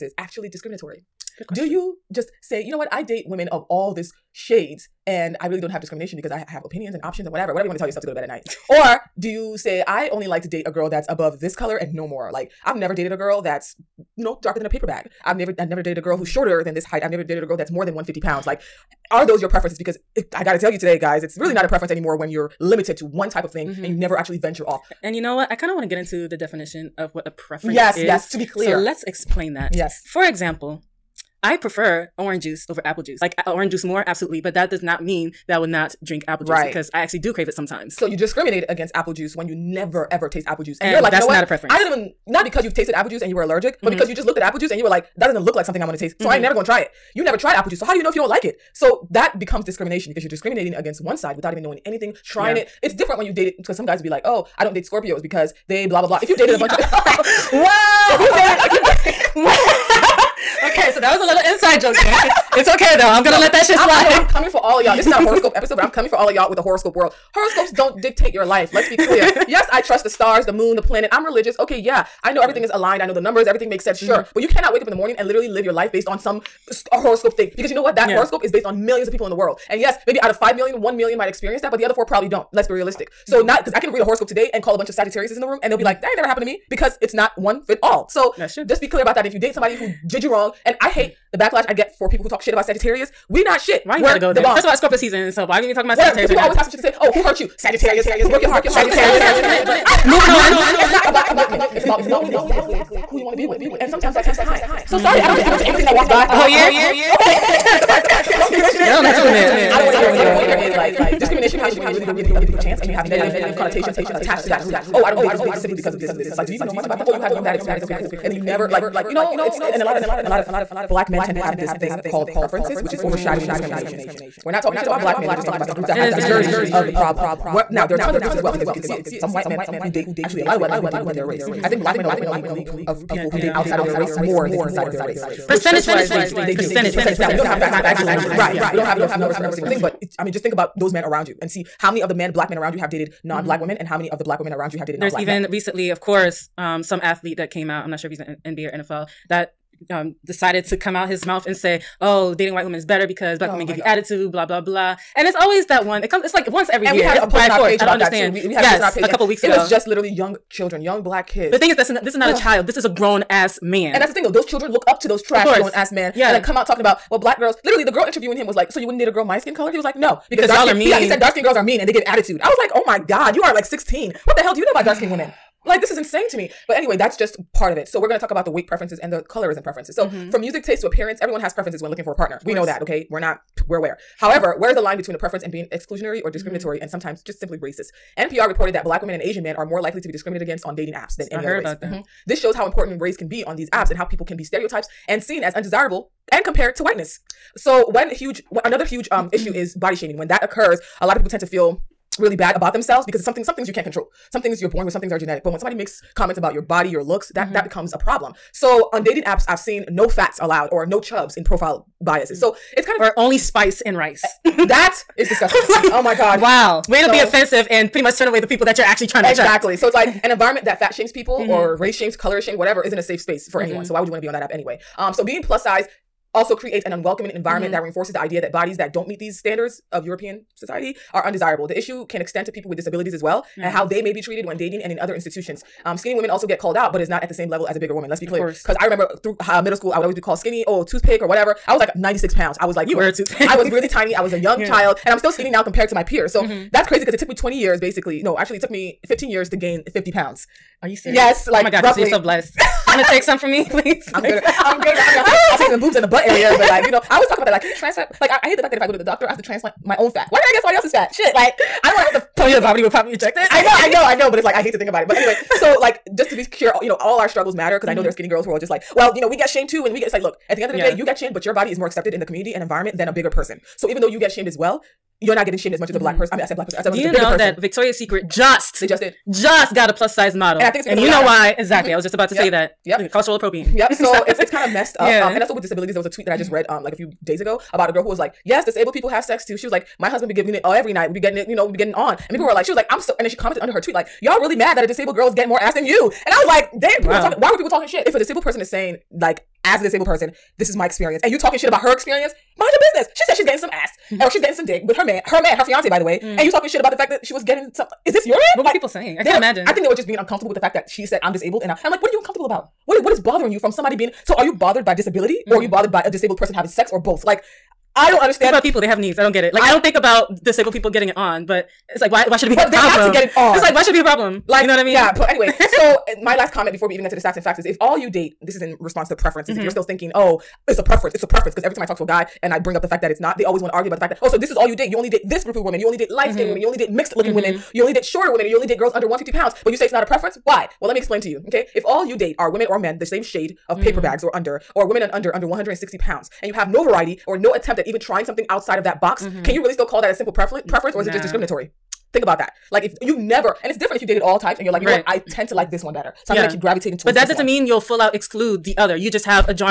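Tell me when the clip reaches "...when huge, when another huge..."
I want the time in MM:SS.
03:17.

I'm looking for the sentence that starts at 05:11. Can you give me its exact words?
And I, I'm like, what are you uncomfortable about?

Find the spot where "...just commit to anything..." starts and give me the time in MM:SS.
01:45.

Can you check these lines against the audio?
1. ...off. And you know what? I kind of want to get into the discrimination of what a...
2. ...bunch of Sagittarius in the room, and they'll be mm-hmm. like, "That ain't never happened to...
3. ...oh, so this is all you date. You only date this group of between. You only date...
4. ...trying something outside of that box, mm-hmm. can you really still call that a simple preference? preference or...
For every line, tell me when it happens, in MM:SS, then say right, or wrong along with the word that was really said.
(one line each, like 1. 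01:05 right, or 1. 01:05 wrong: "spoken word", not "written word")
1. 00:24 wrong: "definition", not "discrimination"
2. 01:24 right
3. 05:34 wrong: "women", not "between"
4. 05:47 right.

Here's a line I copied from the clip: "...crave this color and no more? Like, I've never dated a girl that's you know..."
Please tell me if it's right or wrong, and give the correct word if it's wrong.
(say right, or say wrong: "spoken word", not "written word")
wrong: "above", not "crave".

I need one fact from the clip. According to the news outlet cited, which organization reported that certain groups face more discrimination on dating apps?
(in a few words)
NPR.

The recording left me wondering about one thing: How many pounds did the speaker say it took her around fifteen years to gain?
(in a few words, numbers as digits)
50.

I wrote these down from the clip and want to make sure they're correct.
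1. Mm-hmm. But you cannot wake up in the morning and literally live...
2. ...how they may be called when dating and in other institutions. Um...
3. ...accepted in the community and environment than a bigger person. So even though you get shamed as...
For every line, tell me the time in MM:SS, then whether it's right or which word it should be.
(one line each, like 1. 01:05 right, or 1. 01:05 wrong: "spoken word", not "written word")
1. 01:14 right
2. 03:53 wrong: "treated", not "called"
3. 04:31 right.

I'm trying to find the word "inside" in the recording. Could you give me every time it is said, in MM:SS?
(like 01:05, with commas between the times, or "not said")
01:01, 02:14.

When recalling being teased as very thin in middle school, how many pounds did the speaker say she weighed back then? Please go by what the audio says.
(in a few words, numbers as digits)
96.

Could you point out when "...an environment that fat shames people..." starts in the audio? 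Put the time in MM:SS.
03:40.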